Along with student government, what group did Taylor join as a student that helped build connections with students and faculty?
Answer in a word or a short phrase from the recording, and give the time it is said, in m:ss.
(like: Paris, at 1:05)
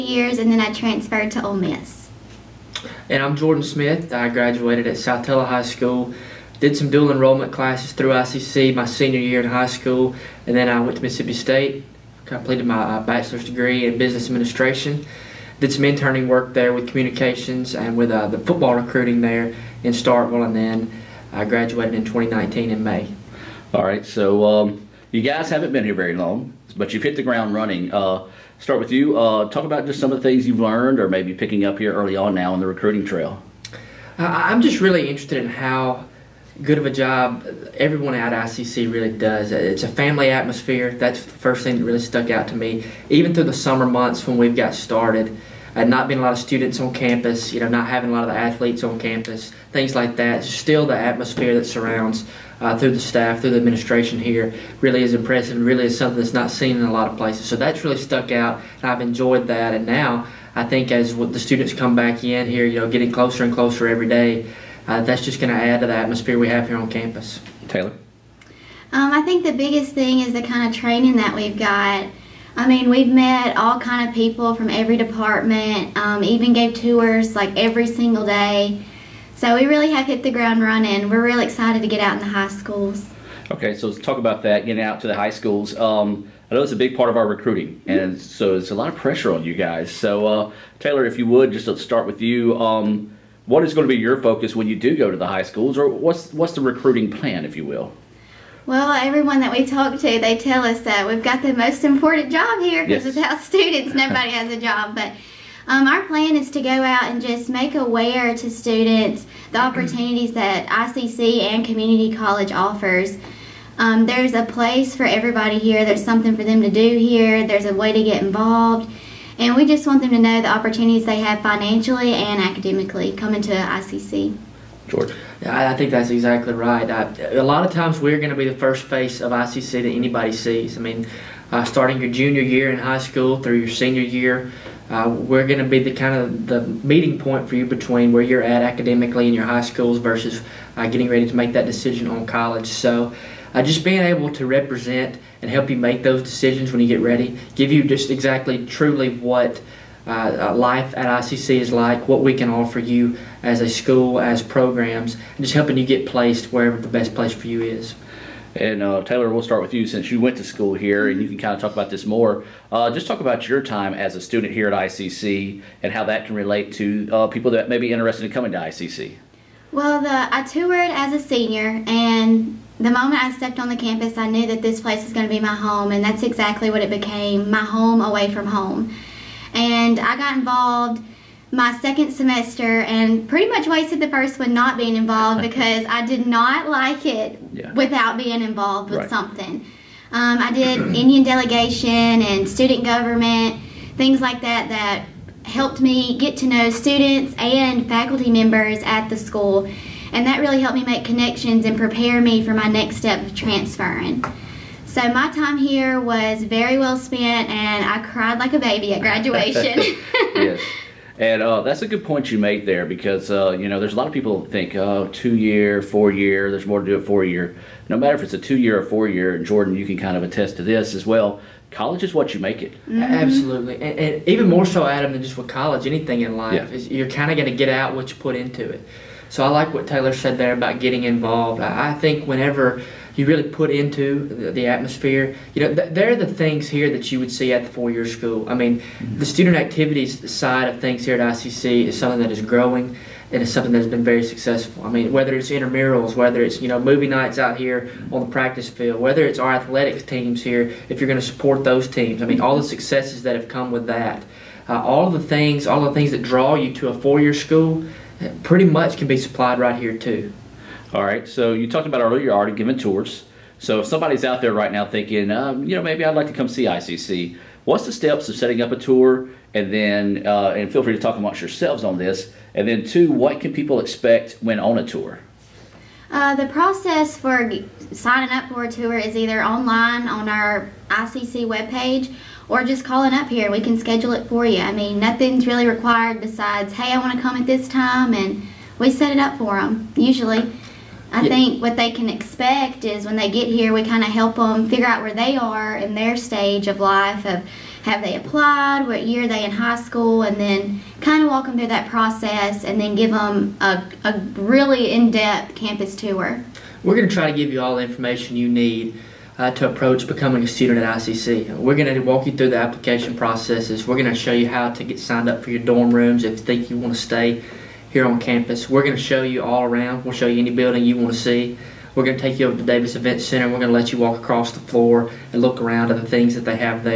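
Indian delegation, at 3:10.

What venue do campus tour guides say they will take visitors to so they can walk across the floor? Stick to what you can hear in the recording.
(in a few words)
Davis Event Center.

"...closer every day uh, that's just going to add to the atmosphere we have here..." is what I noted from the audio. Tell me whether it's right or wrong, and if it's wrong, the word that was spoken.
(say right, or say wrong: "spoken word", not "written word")
right.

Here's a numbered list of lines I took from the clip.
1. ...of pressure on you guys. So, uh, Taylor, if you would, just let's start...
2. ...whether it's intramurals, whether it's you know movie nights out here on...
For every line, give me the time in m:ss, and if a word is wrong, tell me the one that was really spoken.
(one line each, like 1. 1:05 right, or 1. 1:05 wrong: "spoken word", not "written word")
1. 1:28 right
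2. 4:05 right.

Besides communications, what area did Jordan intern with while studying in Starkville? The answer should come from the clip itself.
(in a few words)
football recruiting.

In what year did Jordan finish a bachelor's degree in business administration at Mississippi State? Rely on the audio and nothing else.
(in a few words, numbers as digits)
2019.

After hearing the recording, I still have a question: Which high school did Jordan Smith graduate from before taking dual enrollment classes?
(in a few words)
Saltillo High School.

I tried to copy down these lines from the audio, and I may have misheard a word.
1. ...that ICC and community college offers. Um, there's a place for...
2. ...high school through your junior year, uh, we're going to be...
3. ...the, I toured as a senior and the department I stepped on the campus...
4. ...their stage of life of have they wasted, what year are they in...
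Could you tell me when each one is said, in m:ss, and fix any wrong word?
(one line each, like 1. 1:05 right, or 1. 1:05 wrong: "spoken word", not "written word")
1. 1:50 right
2. 2:12 wrong: "senior", not "junior"
3. 2:50 wrong: "moment", not "department"
4. 4:55 wrong: "applied", not "wasted".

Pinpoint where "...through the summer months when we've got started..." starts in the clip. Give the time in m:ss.
0:43.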